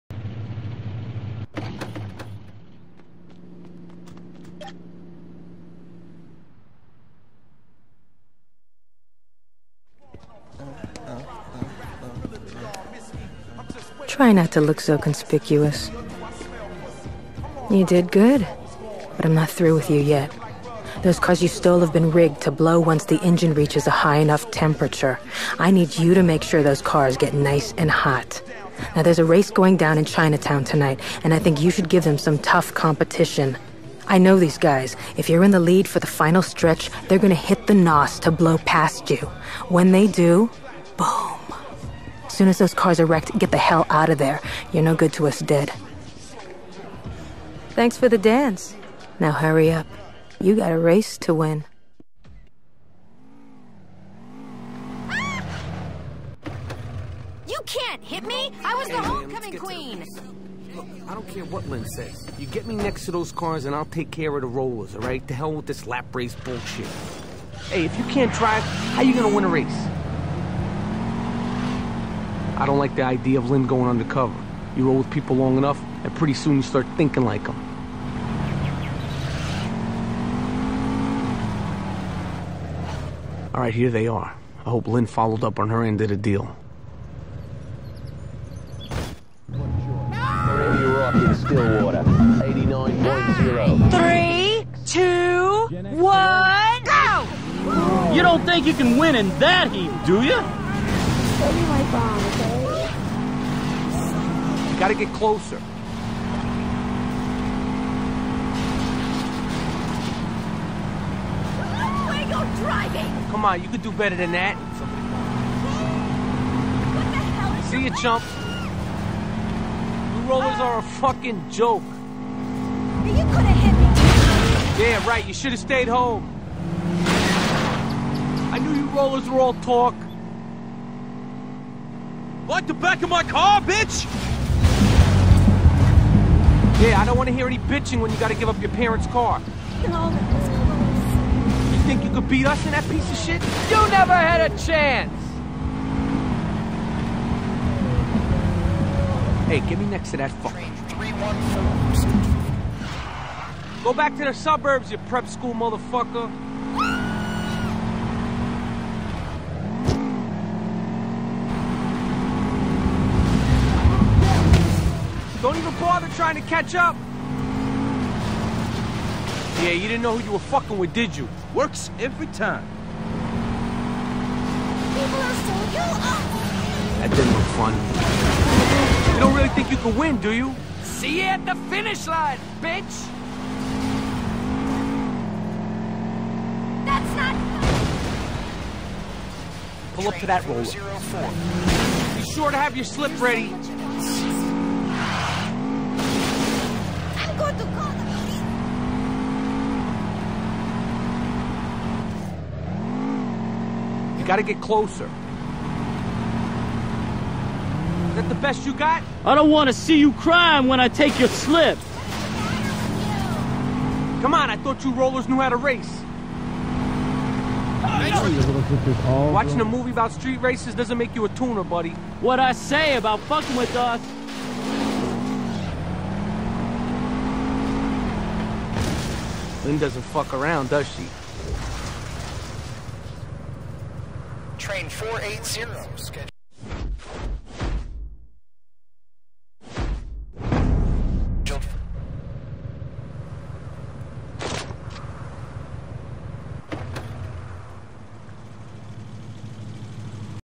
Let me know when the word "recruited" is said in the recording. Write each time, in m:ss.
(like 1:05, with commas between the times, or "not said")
not said.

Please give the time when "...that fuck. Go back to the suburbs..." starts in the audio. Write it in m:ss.
2:30.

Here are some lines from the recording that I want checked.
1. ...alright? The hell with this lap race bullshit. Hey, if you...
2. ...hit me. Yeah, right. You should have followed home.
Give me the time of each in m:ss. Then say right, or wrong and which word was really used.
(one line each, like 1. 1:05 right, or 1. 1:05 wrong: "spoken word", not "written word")
1. 1:04 right
2. 2:03 wrong: "stayed", not "followed".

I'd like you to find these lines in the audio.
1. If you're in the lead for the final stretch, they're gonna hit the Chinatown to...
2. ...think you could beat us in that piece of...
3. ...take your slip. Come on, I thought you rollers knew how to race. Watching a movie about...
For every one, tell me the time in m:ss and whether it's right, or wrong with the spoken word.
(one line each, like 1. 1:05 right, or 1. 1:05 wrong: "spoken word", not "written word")
1. 0:35 wrong: "NOS", not "Chinatown"
2. 2:21 right
3. 3:30 right.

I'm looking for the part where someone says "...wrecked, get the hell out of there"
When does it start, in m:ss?
0:43.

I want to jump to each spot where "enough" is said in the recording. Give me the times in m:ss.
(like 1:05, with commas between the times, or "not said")
0:24, 1:15.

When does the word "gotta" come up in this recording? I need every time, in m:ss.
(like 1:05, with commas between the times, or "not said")
1:44, 2:18.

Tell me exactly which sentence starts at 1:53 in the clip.
Come on, you could do better than that.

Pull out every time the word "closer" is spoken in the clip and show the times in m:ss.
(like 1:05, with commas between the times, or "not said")
1:45, 3:24.